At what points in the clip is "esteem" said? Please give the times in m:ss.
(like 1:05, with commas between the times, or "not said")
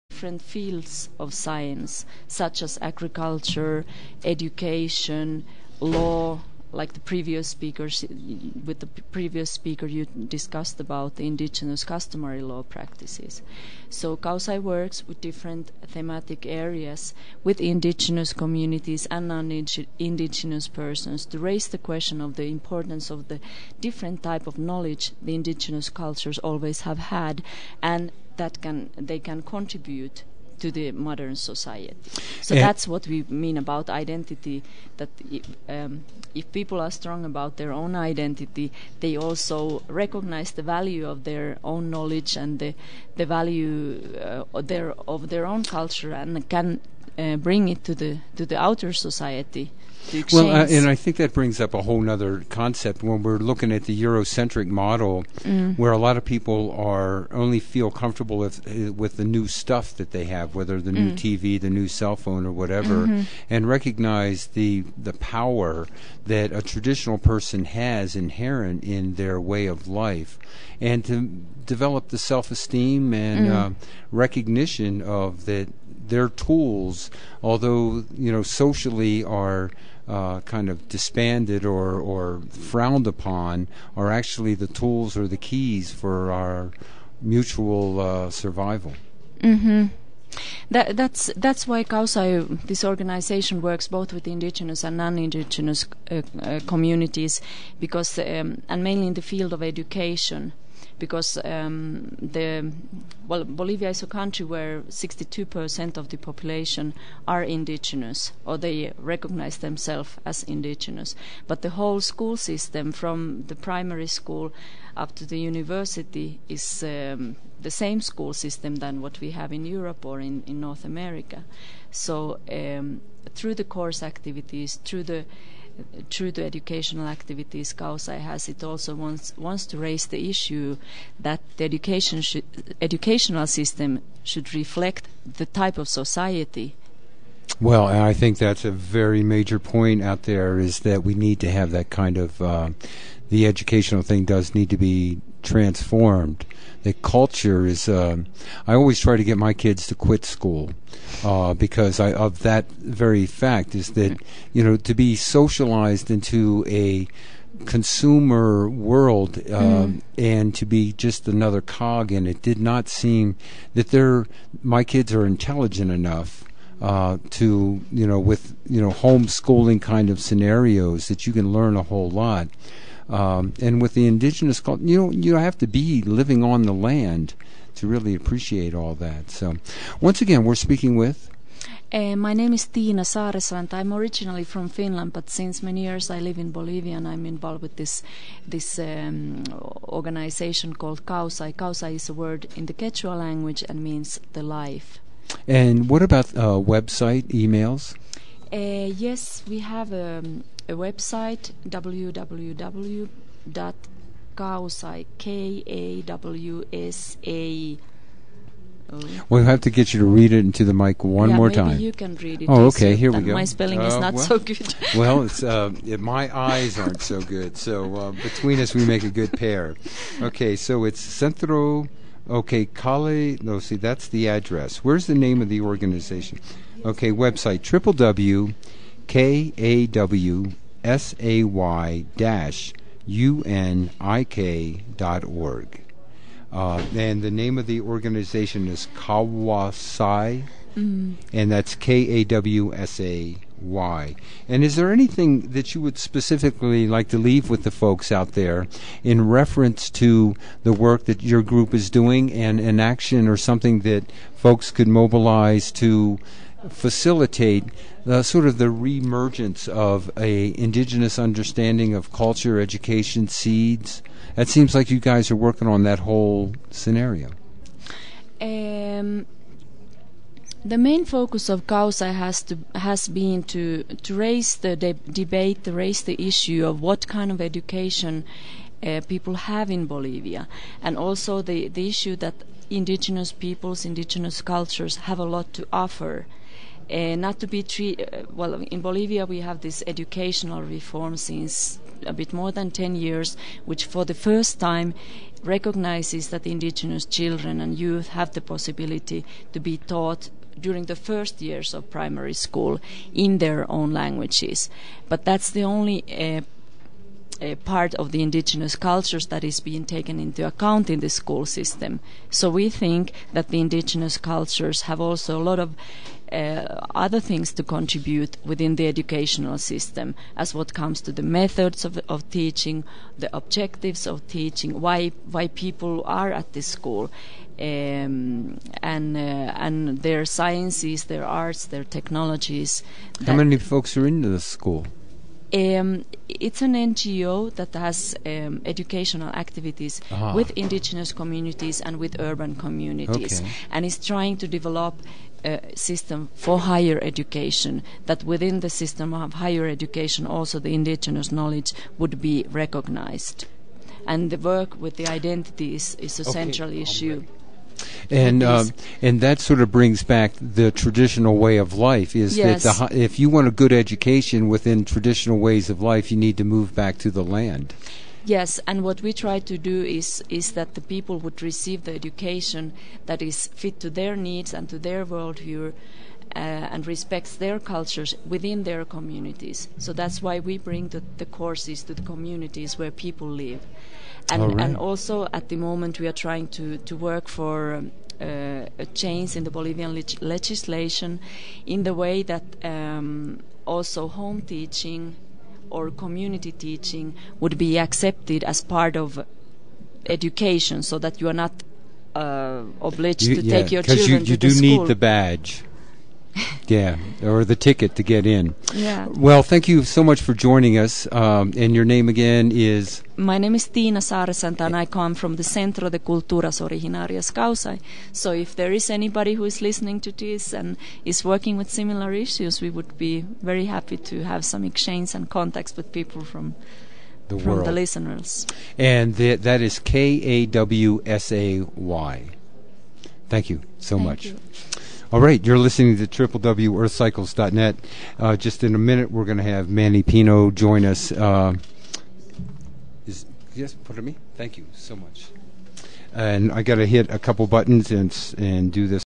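1:12.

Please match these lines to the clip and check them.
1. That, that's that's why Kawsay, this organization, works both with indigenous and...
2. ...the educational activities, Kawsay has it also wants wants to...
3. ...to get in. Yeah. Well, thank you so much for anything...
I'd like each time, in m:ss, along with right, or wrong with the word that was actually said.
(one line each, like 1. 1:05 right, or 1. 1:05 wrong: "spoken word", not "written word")
1. 1:30 right
2. 2:06 right
3. 6:47 wrong: "joining", not "anything".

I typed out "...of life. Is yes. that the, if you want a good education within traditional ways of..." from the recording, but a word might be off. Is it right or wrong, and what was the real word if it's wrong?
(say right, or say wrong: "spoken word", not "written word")
right.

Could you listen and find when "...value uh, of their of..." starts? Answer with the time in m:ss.
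0:43.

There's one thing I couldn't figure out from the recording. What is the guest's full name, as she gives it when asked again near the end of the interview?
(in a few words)
Tina Saresant.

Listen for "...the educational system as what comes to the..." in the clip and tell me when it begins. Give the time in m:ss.
5:18.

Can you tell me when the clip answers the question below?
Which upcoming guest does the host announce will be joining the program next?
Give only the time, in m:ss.
7:19.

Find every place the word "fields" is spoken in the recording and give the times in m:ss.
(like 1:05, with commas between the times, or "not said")
0:00, 1:39.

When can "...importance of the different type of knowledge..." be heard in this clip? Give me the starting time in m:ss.
0:22.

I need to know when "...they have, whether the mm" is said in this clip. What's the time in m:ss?
1:00.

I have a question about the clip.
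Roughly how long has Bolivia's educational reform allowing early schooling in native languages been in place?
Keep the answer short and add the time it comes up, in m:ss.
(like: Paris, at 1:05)
a bit more than 10 years, at 4:52.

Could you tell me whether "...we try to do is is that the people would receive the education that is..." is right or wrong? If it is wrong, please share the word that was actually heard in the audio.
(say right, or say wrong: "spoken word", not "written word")
right.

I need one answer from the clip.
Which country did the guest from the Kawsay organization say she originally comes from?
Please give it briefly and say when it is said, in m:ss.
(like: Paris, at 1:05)
Finland, at 3:04.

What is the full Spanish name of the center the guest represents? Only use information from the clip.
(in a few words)
Centro de Culturas Originarias Kawsay.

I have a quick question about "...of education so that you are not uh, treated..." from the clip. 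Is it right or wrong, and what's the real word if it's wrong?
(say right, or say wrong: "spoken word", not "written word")
wrong: "obliged", not "treated".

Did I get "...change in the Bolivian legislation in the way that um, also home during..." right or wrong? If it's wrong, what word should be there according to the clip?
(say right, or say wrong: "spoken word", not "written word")
wrong: "teaching", not "during".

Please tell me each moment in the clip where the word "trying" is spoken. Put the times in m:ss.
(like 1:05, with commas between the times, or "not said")
5:44, 6:26.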